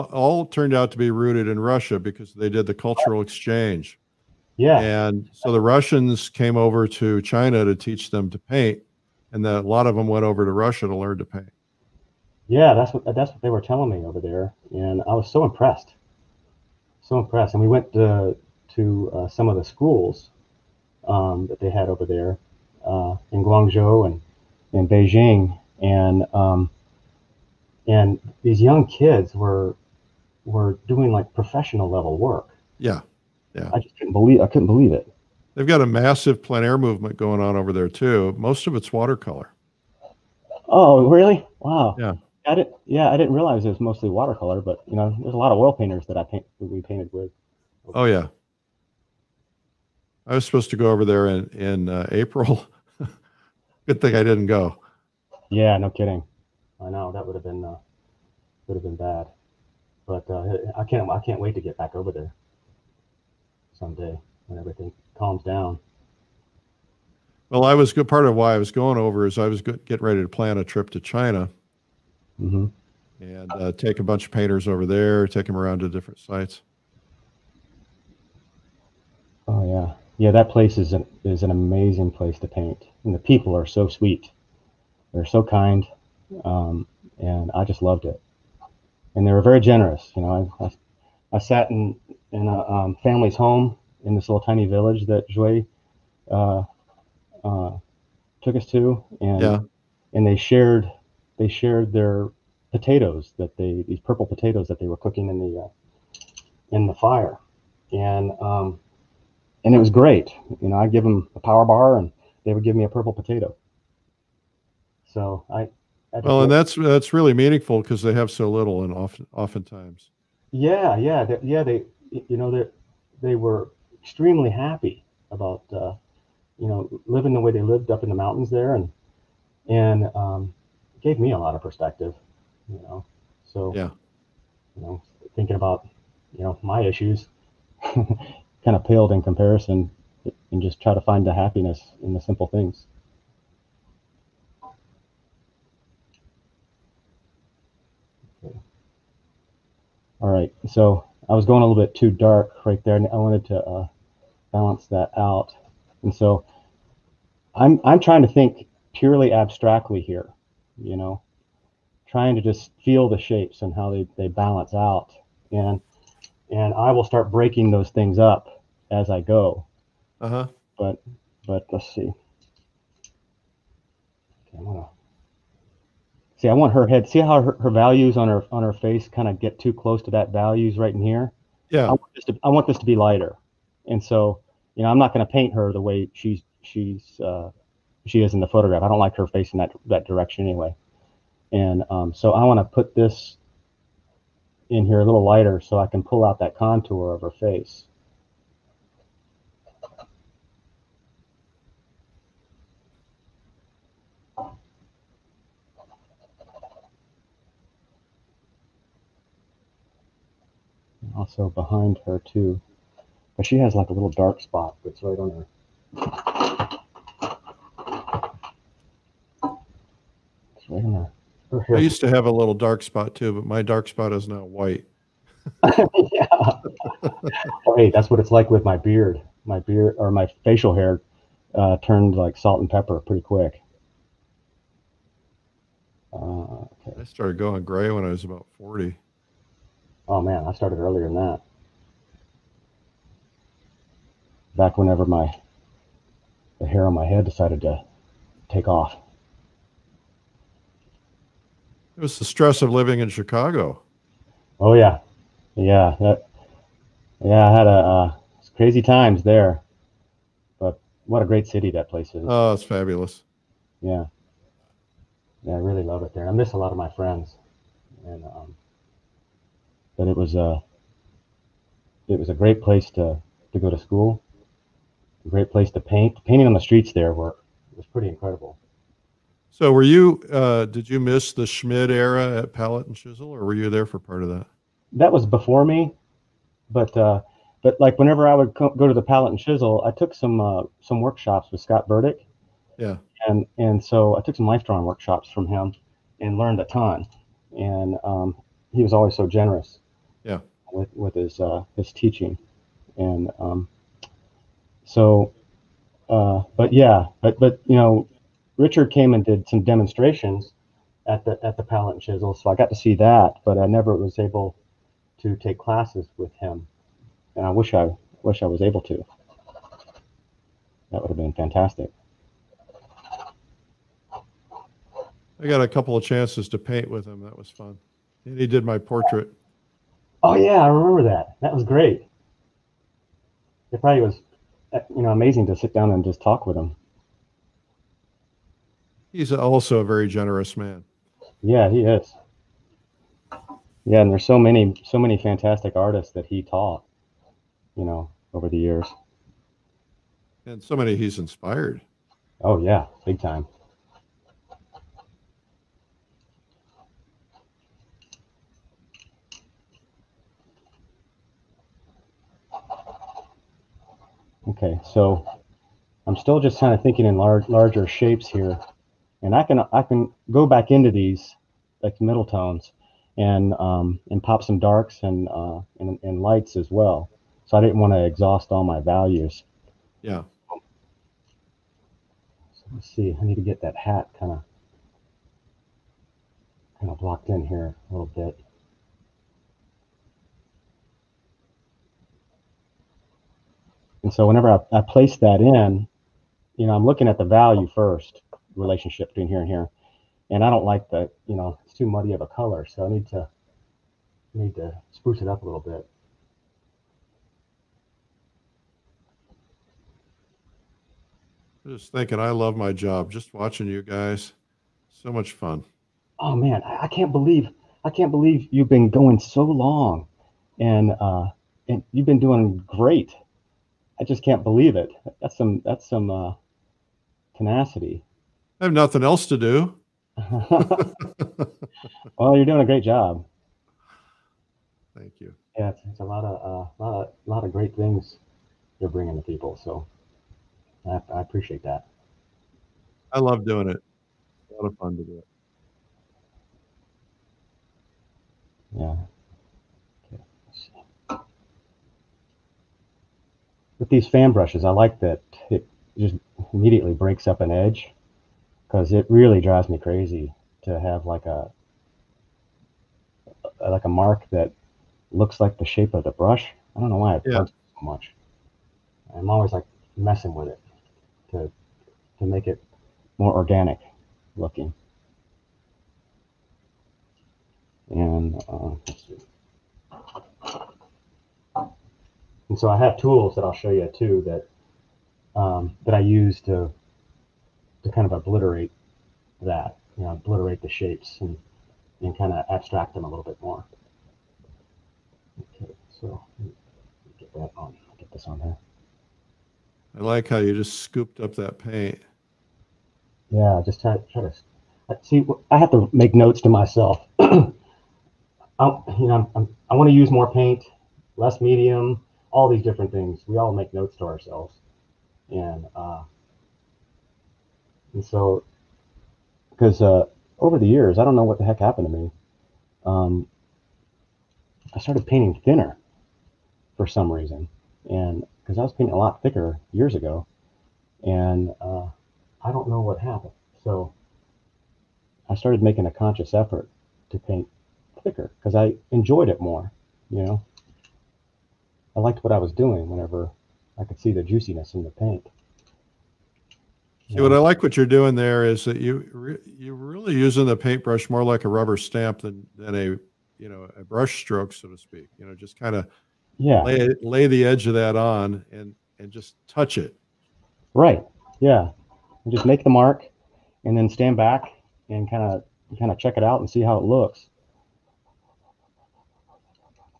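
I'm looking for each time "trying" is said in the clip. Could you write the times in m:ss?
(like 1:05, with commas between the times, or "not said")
2:37, 2:42.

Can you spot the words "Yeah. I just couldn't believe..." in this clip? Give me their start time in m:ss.
0:33.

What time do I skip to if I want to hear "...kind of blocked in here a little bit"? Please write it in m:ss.
6:26.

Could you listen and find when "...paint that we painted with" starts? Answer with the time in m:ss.
0:46.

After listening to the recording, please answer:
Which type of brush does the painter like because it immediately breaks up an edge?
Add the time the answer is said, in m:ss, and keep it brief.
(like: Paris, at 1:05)
Fan brushes, at 7:34.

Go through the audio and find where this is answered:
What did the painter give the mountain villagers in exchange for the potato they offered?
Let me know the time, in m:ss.
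1:51.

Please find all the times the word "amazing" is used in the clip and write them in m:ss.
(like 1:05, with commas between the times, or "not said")
1:21, 5:35.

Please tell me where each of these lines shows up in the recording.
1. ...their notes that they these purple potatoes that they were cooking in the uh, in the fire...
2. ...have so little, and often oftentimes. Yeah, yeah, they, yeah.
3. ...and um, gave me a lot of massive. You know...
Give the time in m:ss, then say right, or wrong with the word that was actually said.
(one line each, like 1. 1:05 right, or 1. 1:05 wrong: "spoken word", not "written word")
1. 1:41 wrong: "potatoes", not "notes"
2. 1:58 right
3. 2:09 wrong: "perspective", not "massive".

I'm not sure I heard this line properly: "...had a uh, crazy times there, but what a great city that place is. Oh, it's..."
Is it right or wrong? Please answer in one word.
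right.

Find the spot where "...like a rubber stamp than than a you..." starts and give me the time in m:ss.
9:11.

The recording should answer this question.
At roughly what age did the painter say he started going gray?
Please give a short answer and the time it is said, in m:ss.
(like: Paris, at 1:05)
40, at 3:58.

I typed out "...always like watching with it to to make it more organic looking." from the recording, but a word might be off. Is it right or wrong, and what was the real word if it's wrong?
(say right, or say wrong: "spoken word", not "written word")
wrong: "messing", not "watching".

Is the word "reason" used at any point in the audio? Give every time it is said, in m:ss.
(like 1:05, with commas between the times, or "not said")
8:47.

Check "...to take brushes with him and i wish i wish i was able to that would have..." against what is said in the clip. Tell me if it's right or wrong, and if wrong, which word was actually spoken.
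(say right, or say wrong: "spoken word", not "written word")
wrong: "classes", not "brushes".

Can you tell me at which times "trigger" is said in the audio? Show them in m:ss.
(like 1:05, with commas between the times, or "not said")
not said.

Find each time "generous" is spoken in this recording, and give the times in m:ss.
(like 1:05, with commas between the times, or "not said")
1:29, 4:59, 5:40.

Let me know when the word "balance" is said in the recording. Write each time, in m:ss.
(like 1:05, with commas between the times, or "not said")
2:34, 2:44.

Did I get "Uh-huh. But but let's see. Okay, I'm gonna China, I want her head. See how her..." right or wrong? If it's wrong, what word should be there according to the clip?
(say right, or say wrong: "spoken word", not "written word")
wrong: "See", not "China".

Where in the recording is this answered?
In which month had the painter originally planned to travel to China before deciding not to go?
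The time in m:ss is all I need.
0:52.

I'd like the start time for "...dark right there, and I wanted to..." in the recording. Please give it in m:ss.
2:32.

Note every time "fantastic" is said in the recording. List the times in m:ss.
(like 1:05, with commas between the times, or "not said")
5:21, 5:45.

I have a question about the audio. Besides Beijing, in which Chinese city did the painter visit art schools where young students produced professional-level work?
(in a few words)
Guangzhou.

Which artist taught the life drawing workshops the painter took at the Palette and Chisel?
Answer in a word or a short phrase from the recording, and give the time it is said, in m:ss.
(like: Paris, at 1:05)
Scott Burdick, at 4:51.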